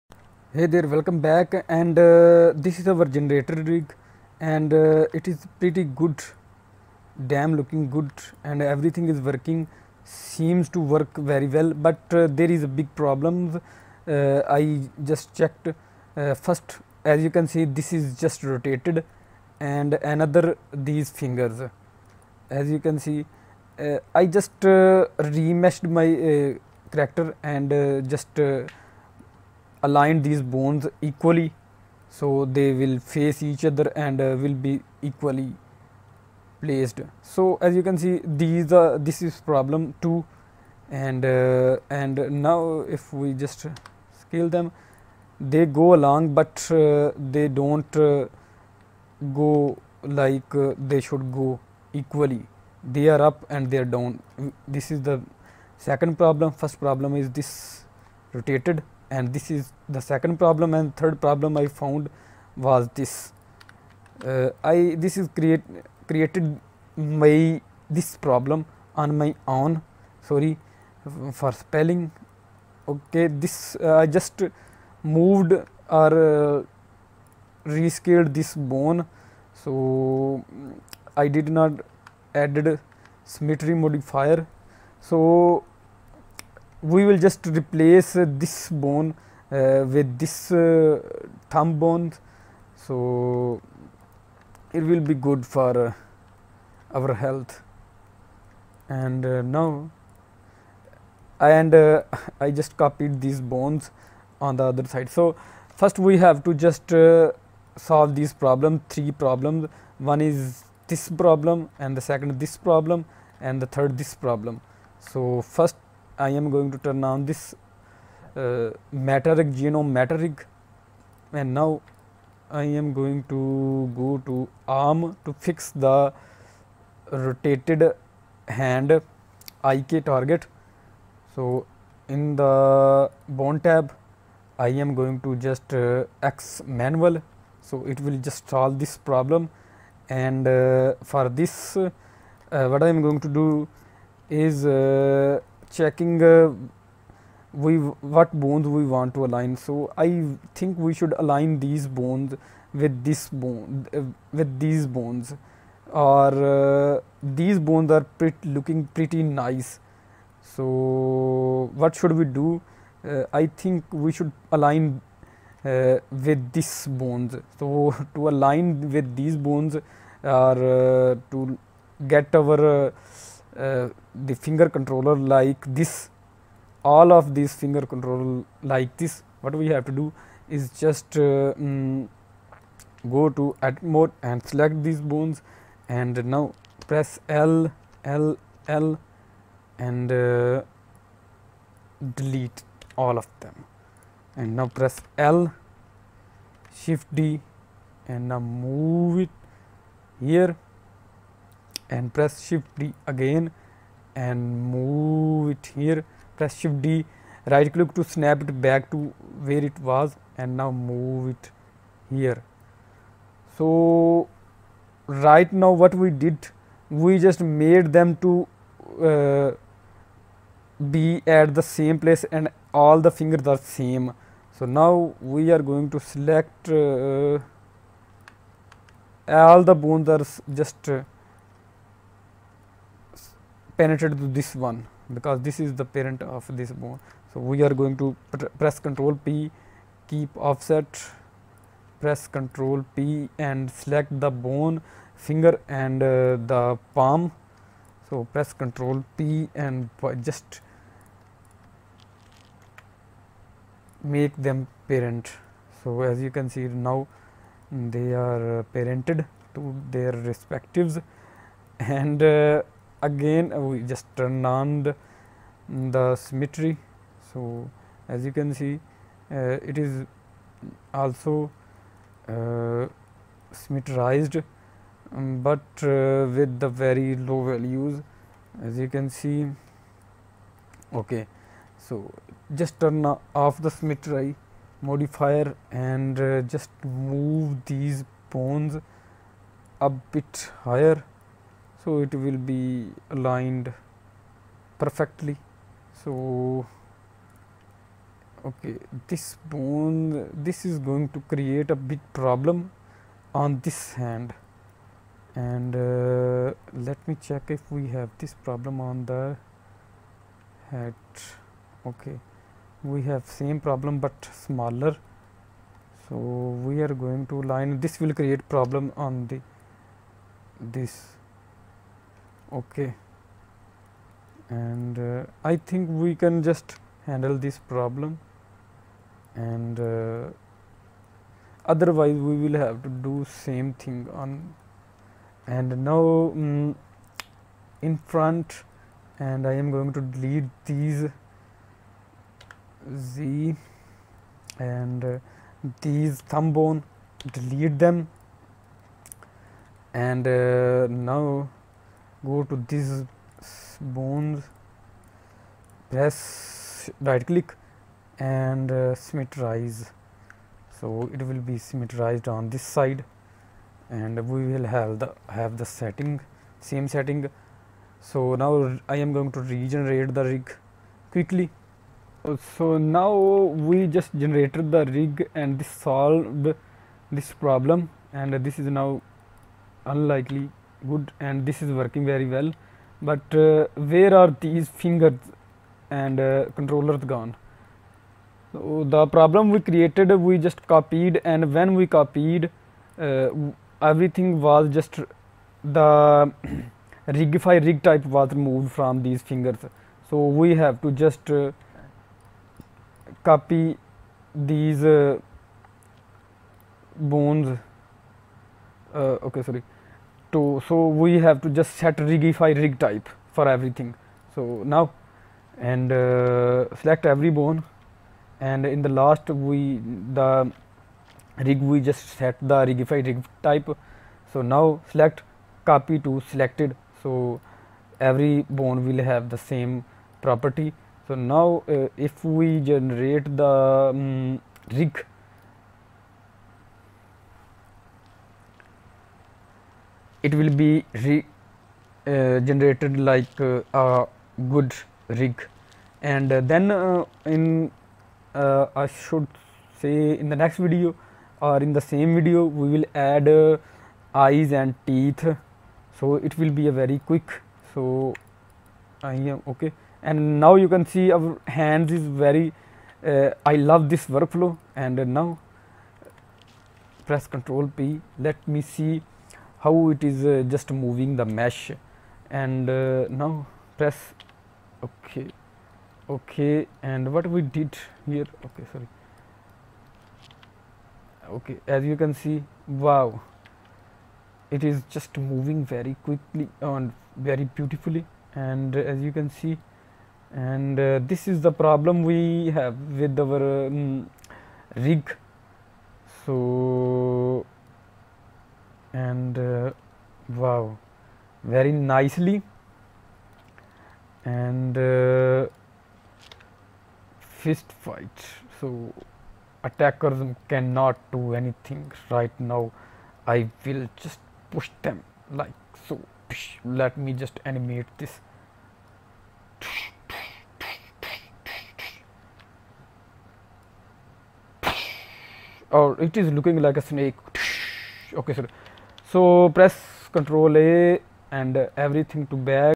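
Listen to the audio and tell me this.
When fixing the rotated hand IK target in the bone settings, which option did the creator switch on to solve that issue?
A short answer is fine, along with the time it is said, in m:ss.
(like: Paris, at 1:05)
Manual, at 2:16.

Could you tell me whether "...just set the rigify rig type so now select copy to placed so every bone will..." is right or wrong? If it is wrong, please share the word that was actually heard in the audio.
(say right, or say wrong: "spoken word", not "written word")
wrong: "selected", not "placed".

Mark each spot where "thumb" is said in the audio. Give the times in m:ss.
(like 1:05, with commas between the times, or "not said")
1:31, 5:46.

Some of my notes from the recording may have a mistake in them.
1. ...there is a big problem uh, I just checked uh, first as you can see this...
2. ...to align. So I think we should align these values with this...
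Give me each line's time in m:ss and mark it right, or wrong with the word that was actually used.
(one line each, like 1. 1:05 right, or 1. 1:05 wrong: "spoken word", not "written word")
1. 0:12 right
2. 2:29 wrong: "bones", not "values".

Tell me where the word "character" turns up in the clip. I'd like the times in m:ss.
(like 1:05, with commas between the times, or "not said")
0:26.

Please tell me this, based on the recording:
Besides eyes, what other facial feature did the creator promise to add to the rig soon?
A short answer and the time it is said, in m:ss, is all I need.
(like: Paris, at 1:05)
Teeth, at 7:34.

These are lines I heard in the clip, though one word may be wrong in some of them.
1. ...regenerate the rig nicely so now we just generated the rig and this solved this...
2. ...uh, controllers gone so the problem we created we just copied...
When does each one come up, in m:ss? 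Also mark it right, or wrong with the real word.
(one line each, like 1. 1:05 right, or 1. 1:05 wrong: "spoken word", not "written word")
1. 6:09 wrong: "quickly", not "nicely"
2. 6:26 right.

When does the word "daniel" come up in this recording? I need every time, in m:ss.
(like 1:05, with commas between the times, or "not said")
not said.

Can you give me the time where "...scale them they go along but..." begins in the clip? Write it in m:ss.
0:44.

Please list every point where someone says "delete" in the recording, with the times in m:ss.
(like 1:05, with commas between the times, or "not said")
3:12, 5:40, 5:47.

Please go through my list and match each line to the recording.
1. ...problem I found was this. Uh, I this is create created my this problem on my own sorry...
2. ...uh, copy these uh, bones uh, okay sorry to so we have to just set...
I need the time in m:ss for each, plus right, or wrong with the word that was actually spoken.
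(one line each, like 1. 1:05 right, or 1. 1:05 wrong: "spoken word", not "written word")
1. 1:01 right
2. 6:41 right.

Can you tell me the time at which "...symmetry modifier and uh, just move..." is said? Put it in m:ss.
4:43.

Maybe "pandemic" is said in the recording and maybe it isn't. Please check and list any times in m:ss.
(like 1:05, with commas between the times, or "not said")
not said.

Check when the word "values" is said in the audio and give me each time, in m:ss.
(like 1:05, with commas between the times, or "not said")
4:37.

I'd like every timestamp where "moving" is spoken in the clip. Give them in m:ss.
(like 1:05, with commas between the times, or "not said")
7:50, 8:05.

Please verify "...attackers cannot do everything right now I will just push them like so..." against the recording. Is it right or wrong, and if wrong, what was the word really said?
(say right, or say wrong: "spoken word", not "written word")
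wrong: "anything", not "everything".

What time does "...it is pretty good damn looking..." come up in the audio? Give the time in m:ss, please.
0:05.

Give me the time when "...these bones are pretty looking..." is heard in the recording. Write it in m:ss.
2:37.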